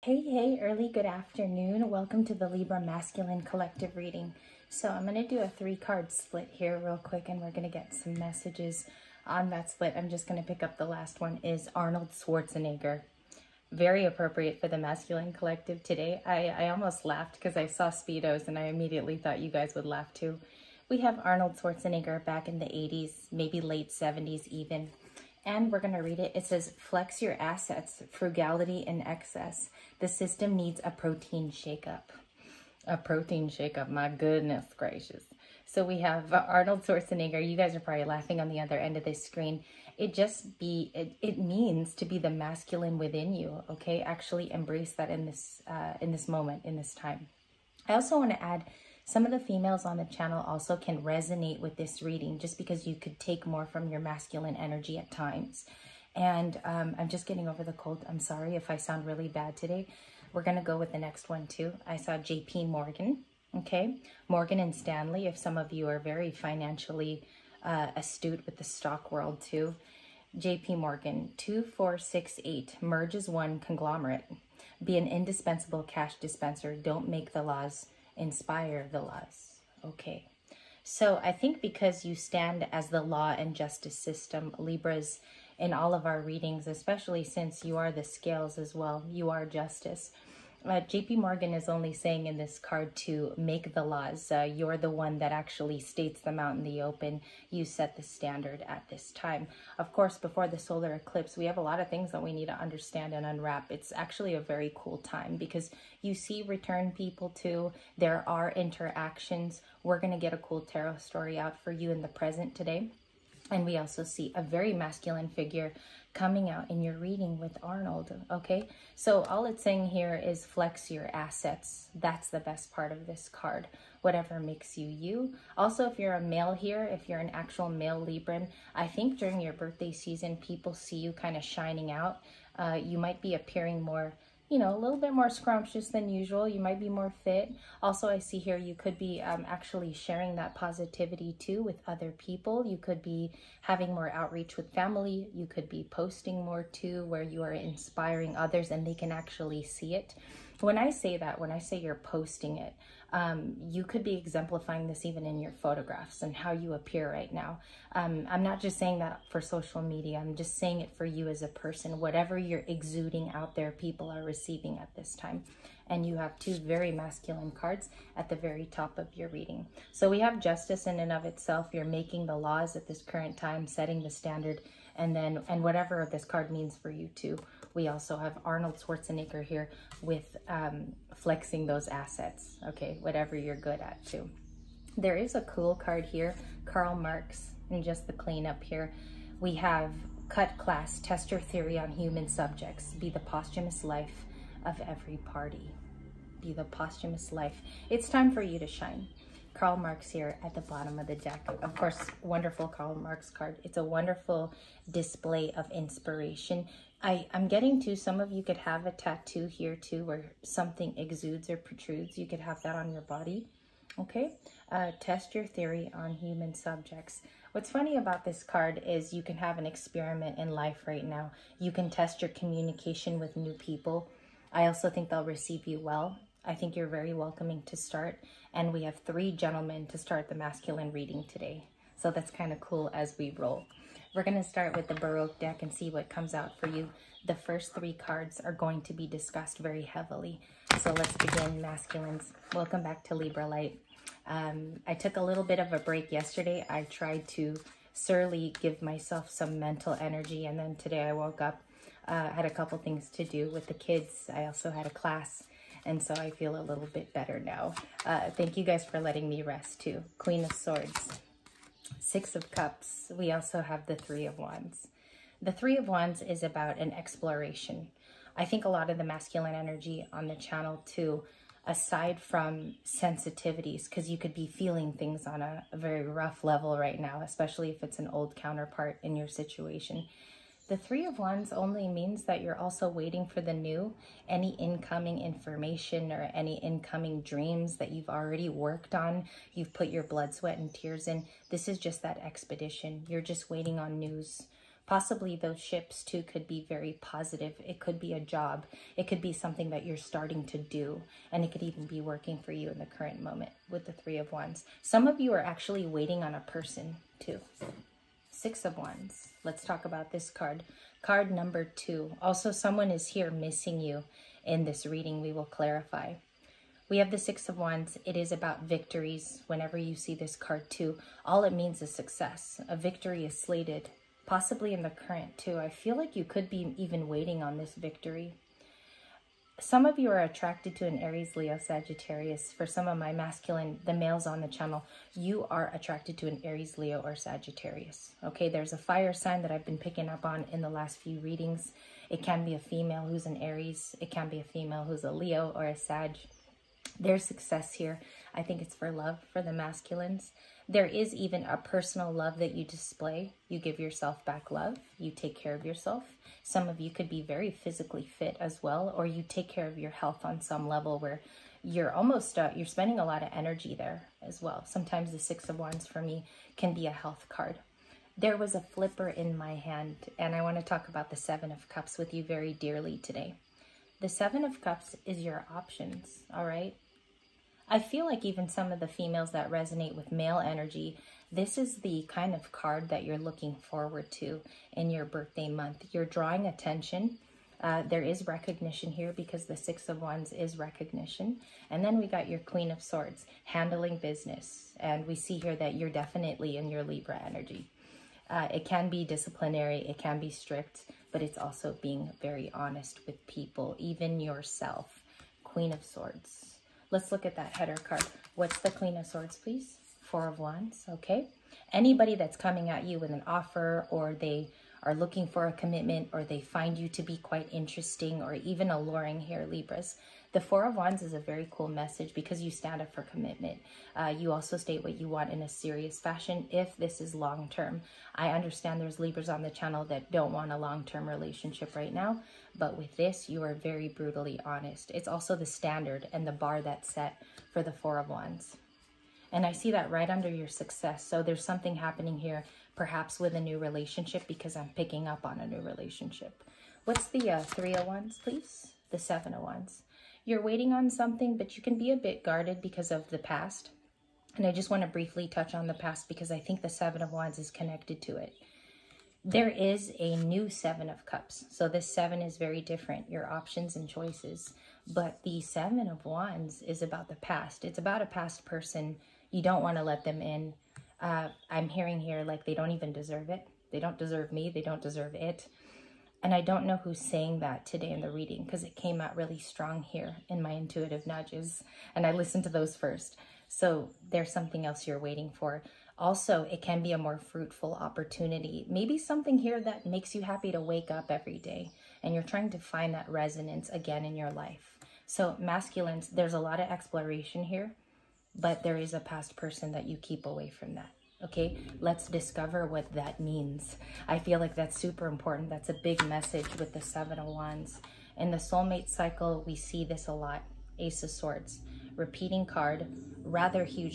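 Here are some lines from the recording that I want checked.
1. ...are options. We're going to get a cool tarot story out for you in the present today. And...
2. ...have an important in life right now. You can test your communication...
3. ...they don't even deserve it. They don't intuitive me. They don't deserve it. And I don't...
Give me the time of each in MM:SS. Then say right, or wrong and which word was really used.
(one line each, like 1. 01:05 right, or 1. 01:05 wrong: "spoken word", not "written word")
1. 01:48 wrong: "interactions", not "options"
2. 03:39 wrong: "experiment", not "important"
3. 07:52 wrong: "deserve", not "intuitive".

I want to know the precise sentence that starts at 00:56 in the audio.
And um, I'm just getting over the cold.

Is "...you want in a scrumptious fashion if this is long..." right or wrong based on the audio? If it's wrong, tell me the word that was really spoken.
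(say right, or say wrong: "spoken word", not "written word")
wrong: "serious", not "scrumptious".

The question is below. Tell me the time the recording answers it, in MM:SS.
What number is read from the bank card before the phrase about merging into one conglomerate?
01:11.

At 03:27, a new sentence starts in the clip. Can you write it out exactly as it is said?
I, I'm getting to some of you could have a tattoo here too where something exudes or protrudes.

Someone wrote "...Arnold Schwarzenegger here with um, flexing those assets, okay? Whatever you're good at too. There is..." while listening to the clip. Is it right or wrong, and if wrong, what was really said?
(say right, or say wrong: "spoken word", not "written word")
right.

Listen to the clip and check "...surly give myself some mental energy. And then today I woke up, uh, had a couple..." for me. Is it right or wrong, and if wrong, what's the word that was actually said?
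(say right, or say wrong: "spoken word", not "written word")
right.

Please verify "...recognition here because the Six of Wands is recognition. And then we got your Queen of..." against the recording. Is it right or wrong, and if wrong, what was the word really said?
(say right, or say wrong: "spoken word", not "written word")
right.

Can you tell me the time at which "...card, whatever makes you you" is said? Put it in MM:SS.
02:03.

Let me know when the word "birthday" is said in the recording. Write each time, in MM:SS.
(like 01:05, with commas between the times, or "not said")
02:09, 06:25.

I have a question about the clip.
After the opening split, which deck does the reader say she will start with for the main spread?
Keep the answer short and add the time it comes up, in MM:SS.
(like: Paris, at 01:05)
The Baroque deck, at 03:54.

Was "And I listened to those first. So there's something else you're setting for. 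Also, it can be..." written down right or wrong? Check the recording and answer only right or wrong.
wrong.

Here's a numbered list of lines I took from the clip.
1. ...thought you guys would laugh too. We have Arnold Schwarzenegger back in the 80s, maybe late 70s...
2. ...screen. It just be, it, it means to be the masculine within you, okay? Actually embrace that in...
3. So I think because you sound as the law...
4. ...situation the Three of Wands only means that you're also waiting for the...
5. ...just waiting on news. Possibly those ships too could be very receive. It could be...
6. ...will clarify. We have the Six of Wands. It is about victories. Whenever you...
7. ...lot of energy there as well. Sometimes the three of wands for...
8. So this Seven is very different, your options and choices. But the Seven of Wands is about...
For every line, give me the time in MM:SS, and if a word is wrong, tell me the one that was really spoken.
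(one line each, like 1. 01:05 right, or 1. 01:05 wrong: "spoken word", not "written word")
1. 00:19 right
2. 00:39 right
3. 01:20 wrong: "stand", not "sound"
4. 04:39 right
5. 04:53 wrong: "positive", not "receive"
6. 05:15 right
7. 06:03 wrong: "six", not "three"
8. 07:41 right.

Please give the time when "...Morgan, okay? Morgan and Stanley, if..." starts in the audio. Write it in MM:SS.
01:02.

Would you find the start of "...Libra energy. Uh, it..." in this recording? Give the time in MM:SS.
06:36.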